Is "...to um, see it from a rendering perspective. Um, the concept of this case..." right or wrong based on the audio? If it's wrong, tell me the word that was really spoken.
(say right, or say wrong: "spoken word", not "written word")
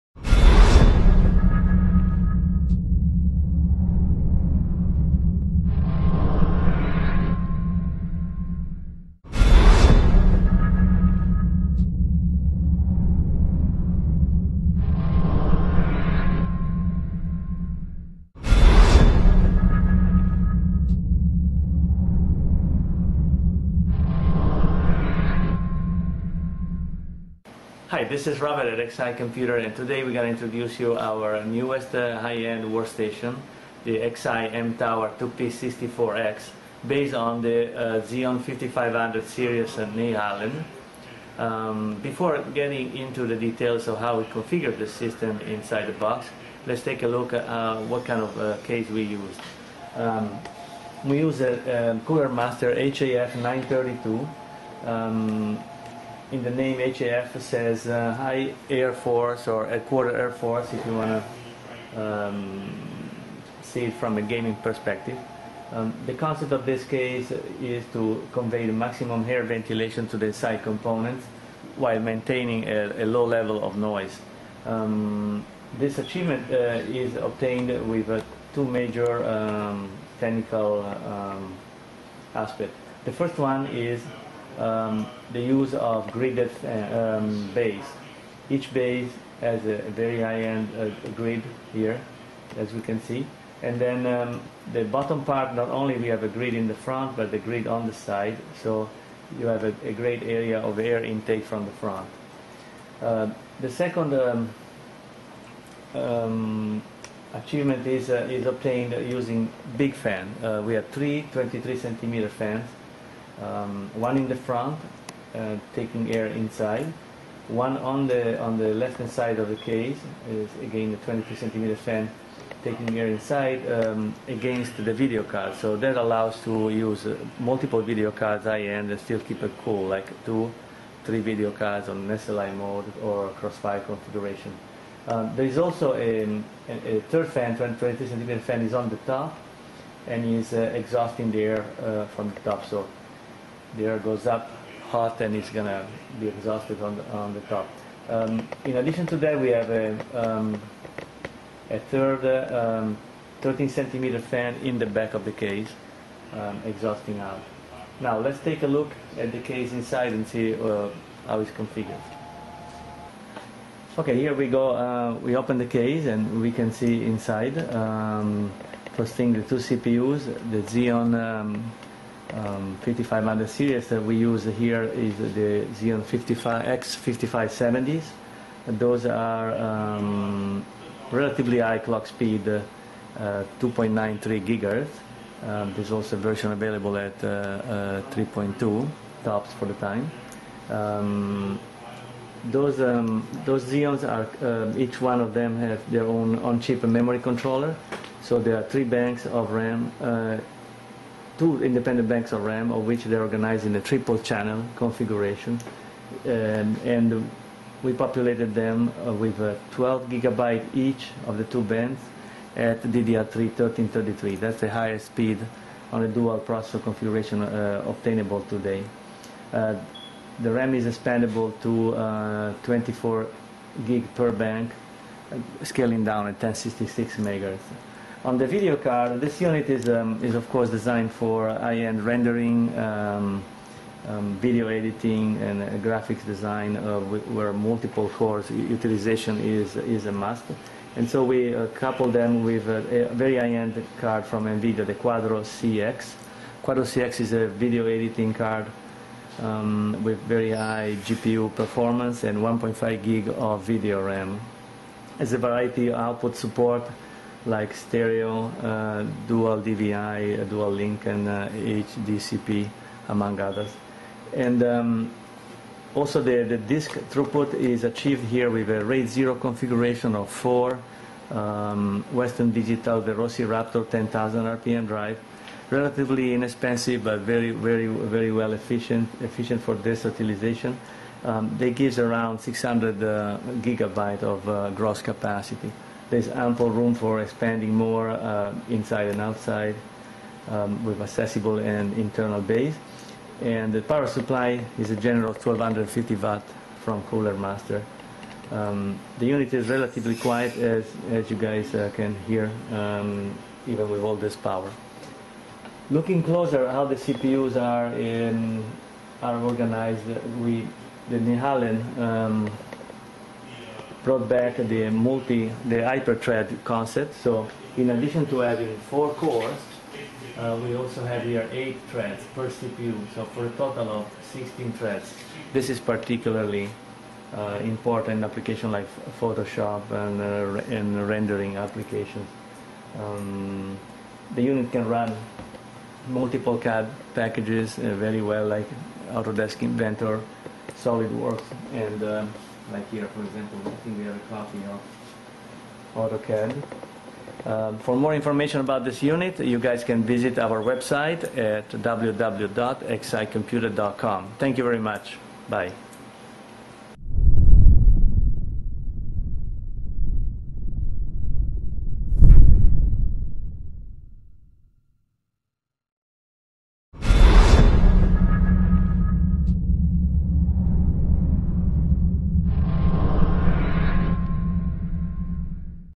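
wrong: "gaming", not "rendering".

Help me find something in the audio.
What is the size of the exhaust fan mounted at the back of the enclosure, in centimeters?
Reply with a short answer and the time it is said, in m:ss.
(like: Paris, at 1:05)
13 centimeter, at 2:33.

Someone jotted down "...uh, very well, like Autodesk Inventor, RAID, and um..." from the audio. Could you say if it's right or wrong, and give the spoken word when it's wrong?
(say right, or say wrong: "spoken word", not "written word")
wrong: "SolidWorks", not "RAID".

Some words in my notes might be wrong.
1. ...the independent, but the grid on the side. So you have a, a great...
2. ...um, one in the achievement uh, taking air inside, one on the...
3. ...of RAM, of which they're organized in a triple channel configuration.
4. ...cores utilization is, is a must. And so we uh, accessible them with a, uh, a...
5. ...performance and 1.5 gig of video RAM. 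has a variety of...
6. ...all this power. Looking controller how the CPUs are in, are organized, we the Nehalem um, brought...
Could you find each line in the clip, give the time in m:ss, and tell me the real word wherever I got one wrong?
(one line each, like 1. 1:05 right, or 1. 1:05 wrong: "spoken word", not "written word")
1. 1:36 wrong: "front", not "independent"
2. 1:53 wrong: "front", not "achievement"
3. 3:22 right
4. 3:58 wrong: "couple", not "accessible"
5. 4:11 right
6. 5:04 wrong: "closer", not "controller".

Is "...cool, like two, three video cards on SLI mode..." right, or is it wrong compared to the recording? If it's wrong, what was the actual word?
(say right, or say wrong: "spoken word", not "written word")
right.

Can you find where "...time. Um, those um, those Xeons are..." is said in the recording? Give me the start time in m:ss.
3:09.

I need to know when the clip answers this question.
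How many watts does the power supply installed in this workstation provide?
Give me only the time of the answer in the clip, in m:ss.
4:55.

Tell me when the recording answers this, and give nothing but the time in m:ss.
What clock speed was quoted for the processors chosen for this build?
3:03.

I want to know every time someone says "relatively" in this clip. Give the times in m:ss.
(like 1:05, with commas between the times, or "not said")
3:01, 4:35, 4:59.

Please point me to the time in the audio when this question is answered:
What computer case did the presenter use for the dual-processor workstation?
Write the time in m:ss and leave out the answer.
0:52.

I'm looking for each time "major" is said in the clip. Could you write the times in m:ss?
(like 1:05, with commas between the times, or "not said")
1:18.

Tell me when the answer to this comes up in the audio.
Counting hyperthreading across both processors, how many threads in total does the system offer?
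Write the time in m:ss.
5:24.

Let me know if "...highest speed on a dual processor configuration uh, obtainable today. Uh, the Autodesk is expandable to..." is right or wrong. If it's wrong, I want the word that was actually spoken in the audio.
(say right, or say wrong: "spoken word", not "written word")
wrong: "RAM", not "Autodesk".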